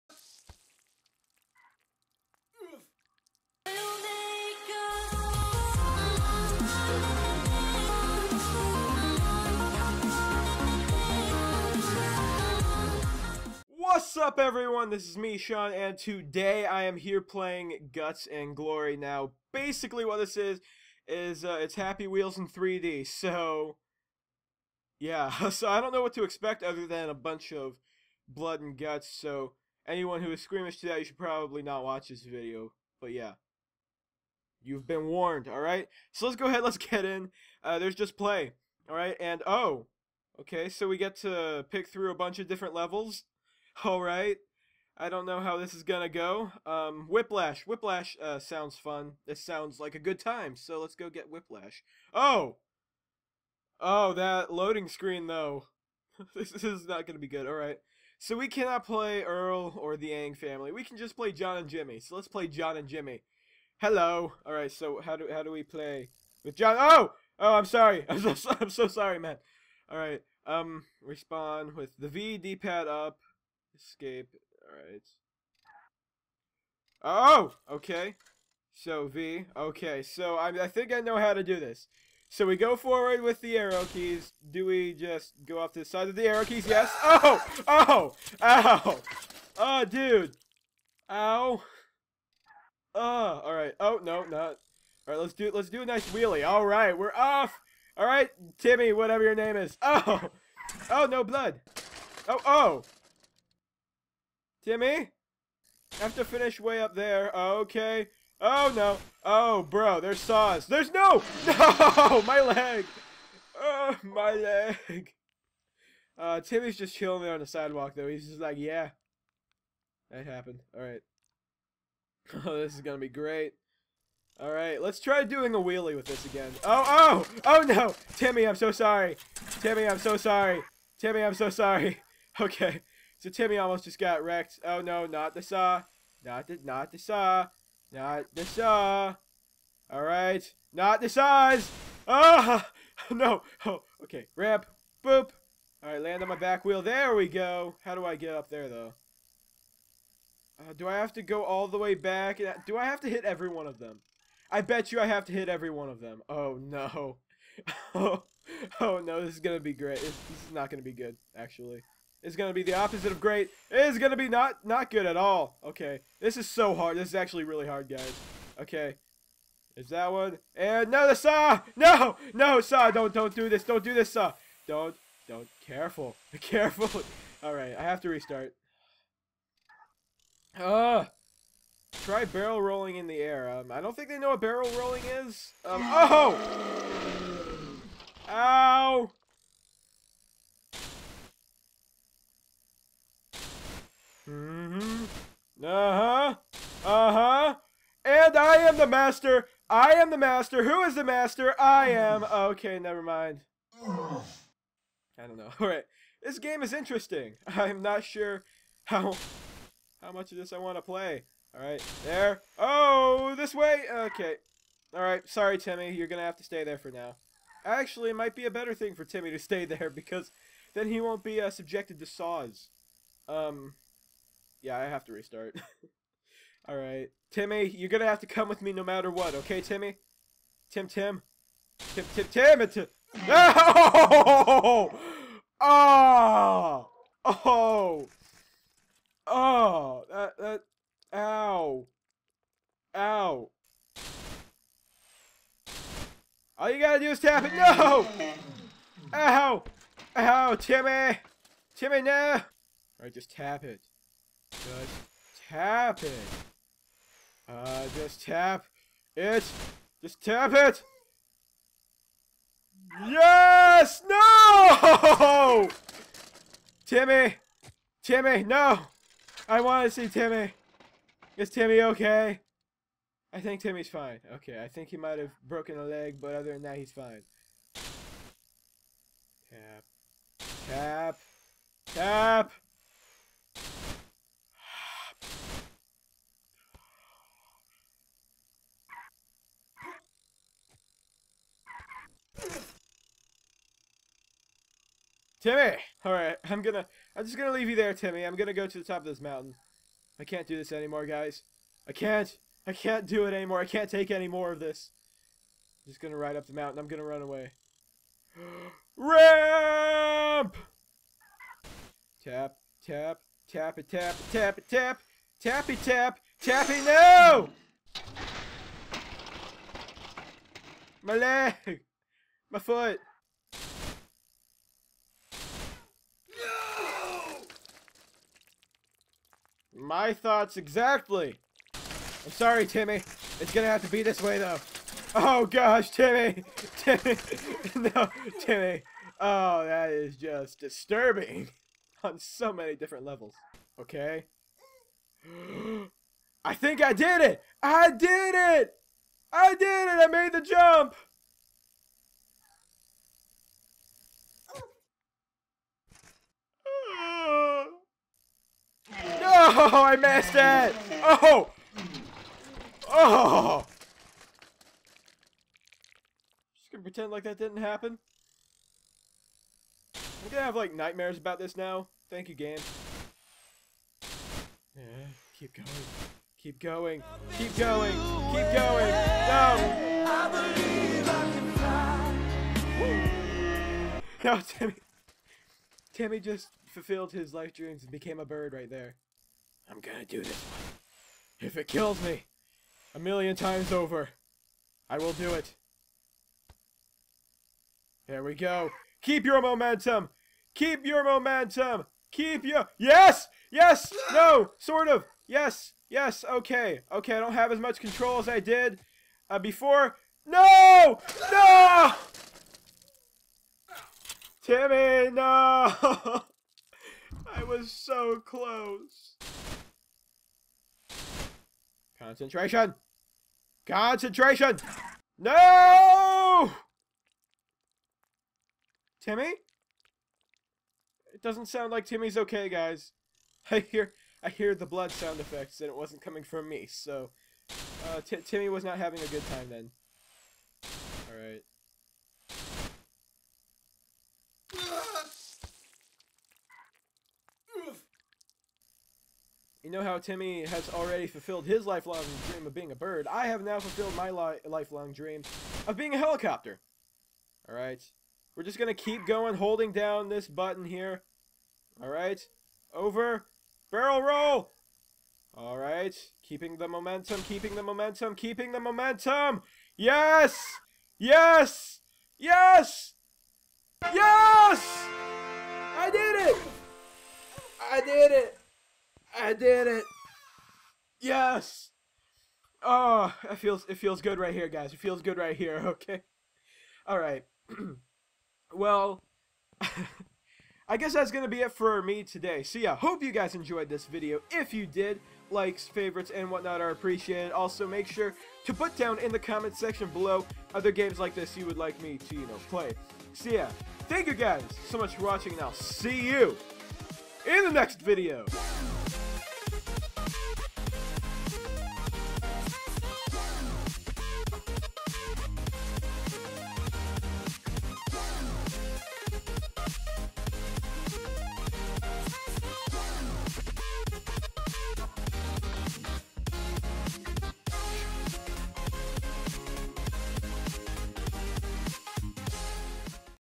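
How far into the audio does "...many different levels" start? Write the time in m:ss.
5:42.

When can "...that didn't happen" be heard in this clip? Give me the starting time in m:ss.
6:07.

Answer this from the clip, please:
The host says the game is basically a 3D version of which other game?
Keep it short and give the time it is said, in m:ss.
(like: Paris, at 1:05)
Happy Wheels, at 0:21.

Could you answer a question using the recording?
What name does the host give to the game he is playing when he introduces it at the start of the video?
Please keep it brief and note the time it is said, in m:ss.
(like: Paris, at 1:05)
Guts and Glory, at 0:17.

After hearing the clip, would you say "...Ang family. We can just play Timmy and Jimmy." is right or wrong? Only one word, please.
wrong.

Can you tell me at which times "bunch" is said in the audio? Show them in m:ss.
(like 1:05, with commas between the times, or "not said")
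0:27, 0:42.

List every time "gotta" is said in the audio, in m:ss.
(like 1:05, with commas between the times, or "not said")
4:06.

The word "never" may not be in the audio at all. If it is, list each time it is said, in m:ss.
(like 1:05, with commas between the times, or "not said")
3:22.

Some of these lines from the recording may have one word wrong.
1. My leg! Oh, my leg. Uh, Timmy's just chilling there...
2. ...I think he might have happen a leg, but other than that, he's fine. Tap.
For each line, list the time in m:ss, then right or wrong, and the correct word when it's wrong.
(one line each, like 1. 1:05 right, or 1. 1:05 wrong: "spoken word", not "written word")
1. 1:52 right
2. 4:34 wrong: "broken", not "happen".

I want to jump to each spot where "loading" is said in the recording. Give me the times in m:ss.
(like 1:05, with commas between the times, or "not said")
0:54.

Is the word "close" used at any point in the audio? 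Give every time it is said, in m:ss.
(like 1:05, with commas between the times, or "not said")
6:58.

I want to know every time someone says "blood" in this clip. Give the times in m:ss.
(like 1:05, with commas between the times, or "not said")
0:28, 1:41, 7:14.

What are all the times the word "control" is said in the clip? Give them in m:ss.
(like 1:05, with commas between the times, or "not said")
6:47.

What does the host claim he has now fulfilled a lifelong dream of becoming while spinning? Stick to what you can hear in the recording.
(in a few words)
a helicopter.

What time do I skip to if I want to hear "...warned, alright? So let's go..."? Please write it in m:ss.
0:35.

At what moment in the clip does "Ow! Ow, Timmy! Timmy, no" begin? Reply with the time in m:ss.
4:09.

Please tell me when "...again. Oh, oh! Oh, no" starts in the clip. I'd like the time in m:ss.
2:06.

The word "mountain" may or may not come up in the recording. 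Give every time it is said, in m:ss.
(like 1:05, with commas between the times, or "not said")
4:59, 5:06.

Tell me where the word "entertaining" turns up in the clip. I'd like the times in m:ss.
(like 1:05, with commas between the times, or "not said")
not said.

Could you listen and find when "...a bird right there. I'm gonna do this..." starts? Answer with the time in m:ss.
6:28.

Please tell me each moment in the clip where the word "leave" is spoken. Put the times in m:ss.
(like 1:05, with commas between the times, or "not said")
4:57.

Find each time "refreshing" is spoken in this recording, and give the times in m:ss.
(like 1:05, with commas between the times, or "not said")
not said.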